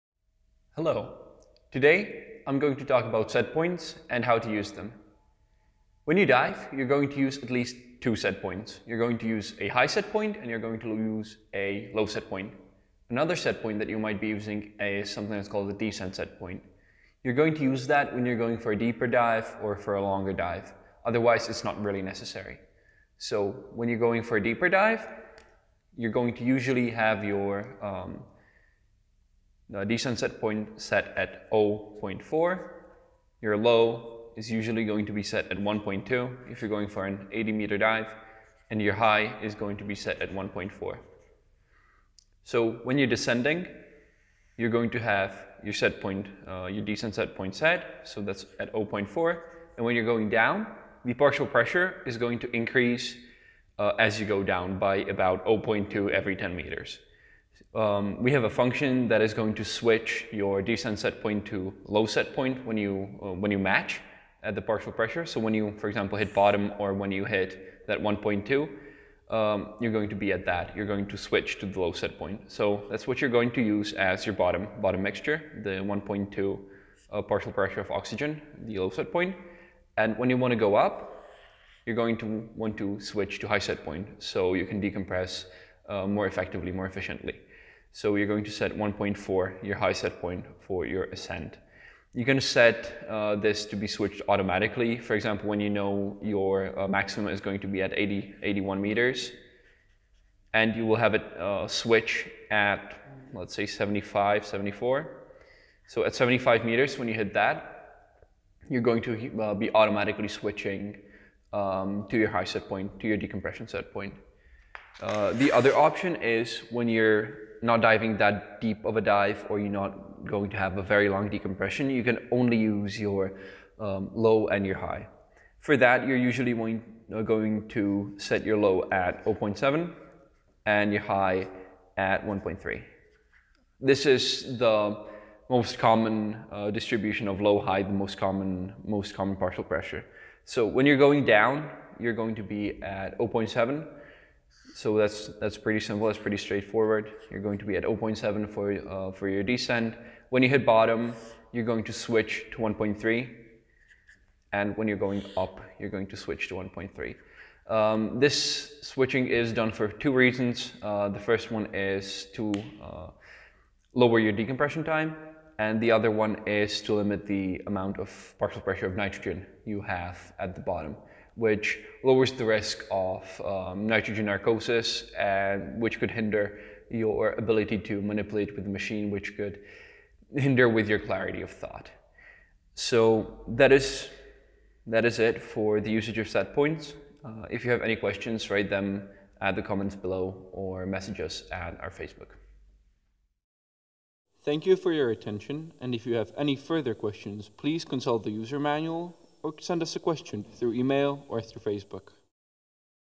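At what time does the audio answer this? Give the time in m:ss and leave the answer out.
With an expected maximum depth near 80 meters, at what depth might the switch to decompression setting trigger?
1:46.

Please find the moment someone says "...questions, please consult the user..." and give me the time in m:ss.
3:16.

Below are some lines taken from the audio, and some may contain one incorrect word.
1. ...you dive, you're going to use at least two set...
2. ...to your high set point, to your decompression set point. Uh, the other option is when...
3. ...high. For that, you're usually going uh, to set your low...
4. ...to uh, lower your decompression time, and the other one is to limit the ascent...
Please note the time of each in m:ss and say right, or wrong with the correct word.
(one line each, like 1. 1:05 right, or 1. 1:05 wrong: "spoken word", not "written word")
1. 0:06 right
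2. 1:52 right
3. 2:04 right
4. 2:42 wrong: "amount", not "ascent".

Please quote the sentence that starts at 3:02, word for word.
So that is that is it for the usage of set points.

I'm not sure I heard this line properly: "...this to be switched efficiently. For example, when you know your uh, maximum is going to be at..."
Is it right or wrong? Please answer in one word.
wrong.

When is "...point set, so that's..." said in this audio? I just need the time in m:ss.
0:47.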